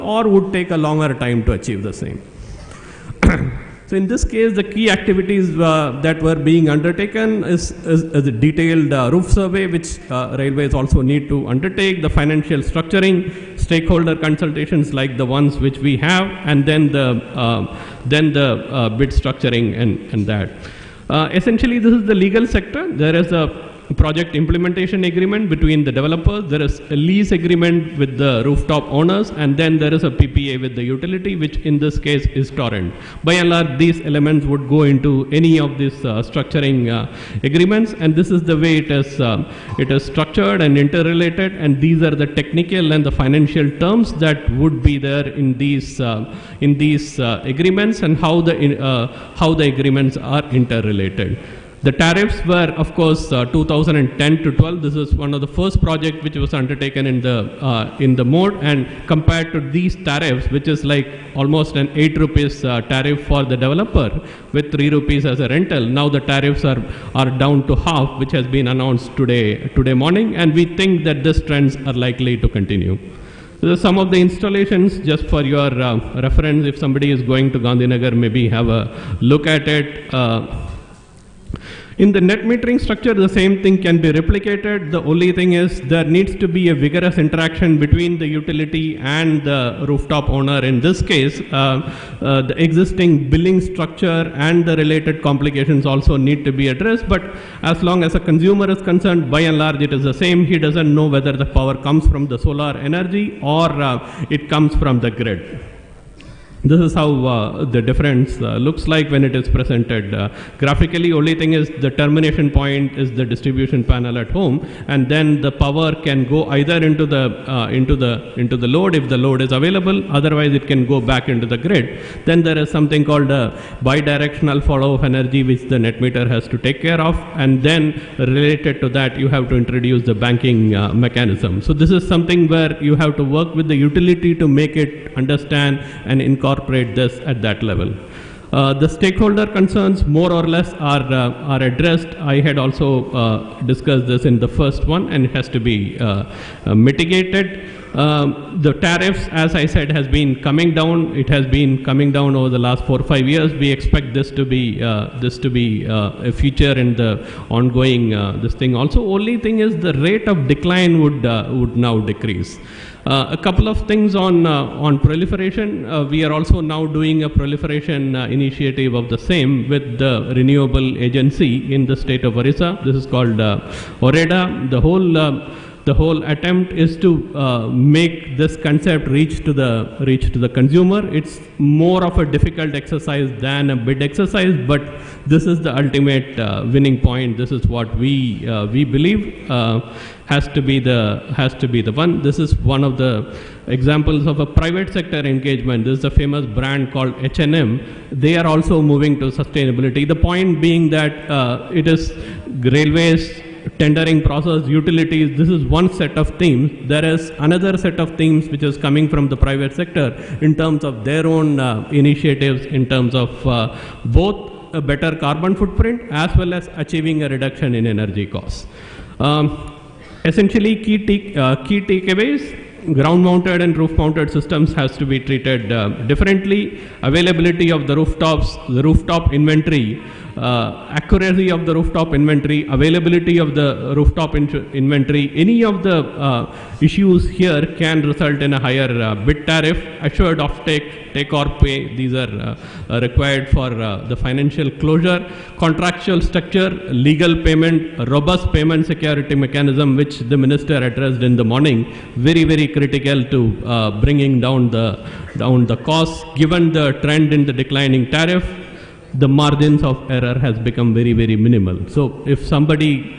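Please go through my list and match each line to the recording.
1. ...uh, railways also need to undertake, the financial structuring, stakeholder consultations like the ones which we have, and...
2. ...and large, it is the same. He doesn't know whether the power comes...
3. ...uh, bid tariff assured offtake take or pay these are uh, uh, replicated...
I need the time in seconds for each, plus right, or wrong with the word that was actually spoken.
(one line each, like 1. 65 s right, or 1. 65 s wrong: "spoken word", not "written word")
1. 10 s right
2. 99 s right
3. 239 s wrong: "required", not "replicated".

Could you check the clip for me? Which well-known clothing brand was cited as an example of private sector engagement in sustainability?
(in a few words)
H&M.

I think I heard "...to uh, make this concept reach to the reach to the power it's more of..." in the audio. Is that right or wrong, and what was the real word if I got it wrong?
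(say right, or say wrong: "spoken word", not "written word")
wrong: "consumer", not "power".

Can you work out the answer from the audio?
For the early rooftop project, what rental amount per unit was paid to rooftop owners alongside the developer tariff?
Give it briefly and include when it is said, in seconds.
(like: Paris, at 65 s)
3 rupees, at 64 s.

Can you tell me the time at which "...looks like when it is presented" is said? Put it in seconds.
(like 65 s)
108 s.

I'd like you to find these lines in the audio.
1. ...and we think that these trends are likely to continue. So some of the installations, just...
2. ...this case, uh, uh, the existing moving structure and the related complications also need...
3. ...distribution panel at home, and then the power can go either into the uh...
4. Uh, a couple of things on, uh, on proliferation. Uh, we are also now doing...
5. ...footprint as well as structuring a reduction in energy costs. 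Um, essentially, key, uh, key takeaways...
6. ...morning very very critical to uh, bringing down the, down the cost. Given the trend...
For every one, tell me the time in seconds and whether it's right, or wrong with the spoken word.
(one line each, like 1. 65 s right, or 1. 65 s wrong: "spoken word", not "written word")
1. 70 s right
2. 90 s wrong: "billing", not "moving"
3. 113 s right
4. 163 s right
5. 215 s wrong: "achieving", not "structuring"
6. 251 s right.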